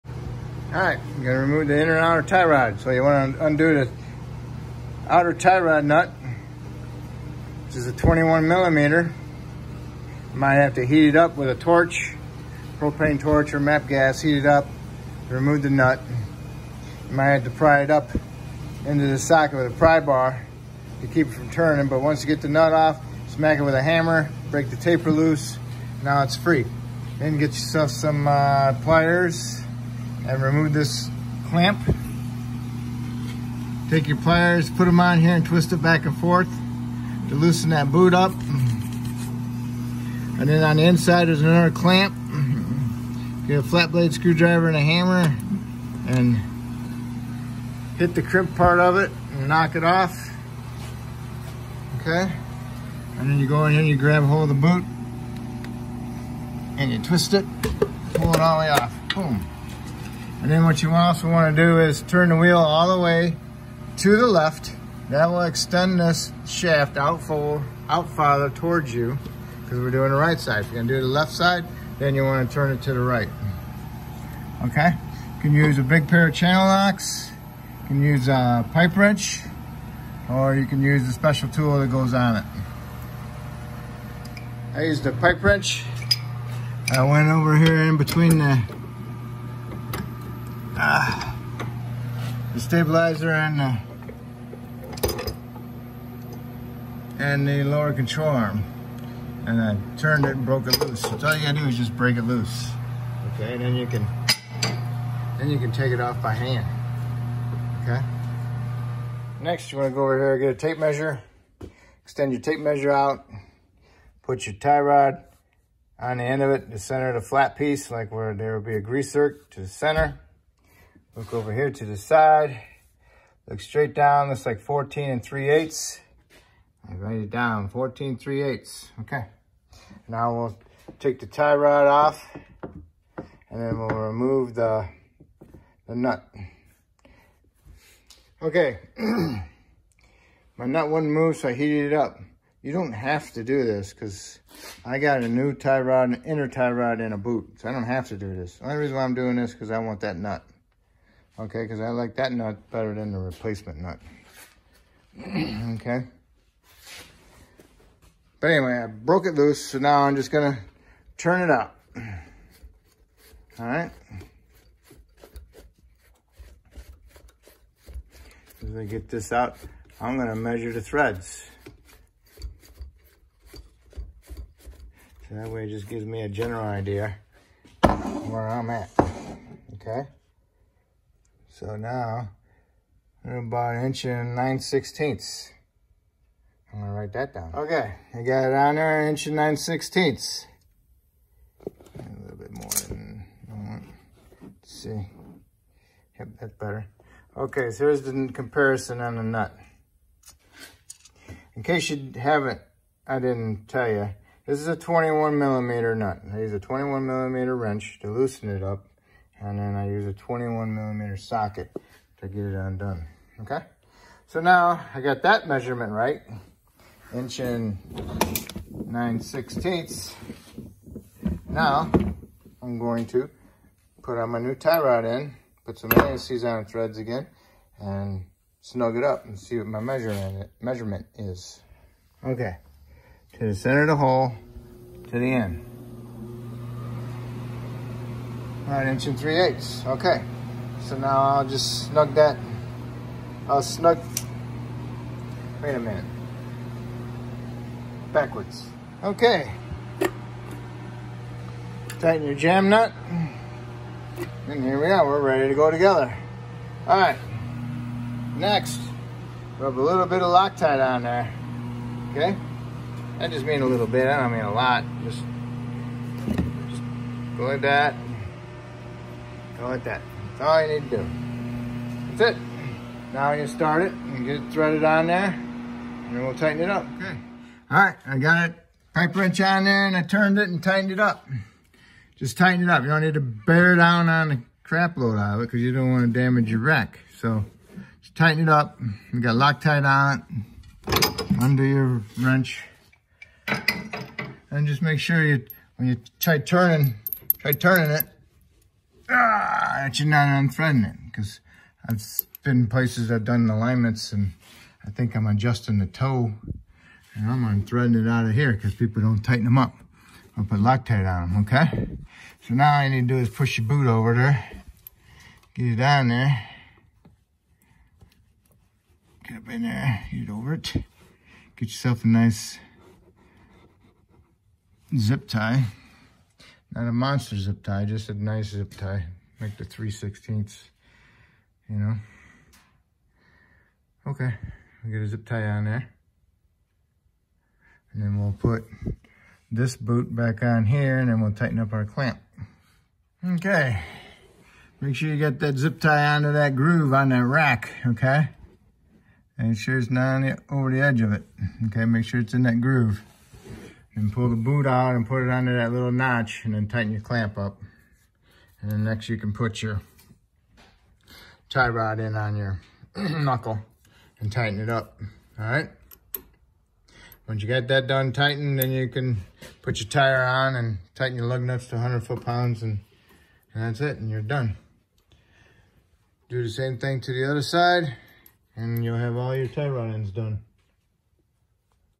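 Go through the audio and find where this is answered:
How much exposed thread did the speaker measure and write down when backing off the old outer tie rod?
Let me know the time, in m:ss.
3:03.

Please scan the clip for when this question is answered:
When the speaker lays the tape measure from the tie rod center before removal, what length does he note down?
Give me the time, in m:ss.
2:04.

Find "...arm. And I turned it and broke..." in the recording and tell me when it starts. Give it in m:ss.
1:38.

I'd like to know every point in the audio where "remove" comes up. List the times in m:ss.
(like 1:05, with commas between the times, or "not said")
0:01, 0:15, 0:30, 2:13.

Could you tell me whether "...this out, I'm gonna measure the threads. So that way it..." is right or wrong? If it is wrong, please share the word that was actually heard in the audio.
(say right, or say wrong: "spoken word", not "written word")
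right.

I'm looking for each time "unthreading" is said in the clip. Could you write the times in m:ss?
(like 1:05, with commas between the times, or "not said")
5:00, 5:07.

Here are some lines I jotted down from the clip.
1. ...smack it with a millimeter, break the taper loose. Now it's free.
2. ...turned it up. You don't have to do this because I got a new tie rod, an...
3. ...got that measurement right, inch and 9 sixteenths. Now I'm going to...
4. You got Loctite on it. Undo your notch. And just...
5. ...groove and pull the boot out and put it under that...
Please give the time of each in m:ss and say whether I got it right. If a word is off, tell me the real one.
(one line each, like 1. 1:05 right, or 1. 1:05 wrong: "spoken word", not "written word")
1. 0:23 wrong: "hammer", not "millimeter"
2. 2:21 wrong: "heated", not "turned"
3. 3:35 right
4. 4:49 wrong: "wrench", not "notch"
5. 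5:52 right.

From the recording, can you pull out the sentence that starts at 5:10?
I'll put Loctite on them, okay?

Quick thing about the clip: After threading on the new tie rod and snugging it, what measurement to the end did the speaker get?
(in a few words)
1 3/8 inches.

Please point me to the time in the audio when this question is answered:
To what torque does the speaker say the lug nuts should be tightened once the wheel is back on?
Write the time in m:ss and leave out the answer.
6:11.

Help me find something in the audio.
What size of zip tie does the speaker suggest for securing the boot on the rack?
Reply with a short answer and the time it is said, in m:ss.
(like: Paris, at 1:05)
3/16, at 5:29.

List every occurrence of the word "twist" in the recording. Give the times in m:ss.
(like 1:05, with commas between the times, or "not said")
0:35, 0:56.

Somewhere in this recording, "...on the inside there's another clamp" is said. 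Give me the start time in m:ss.
0:40.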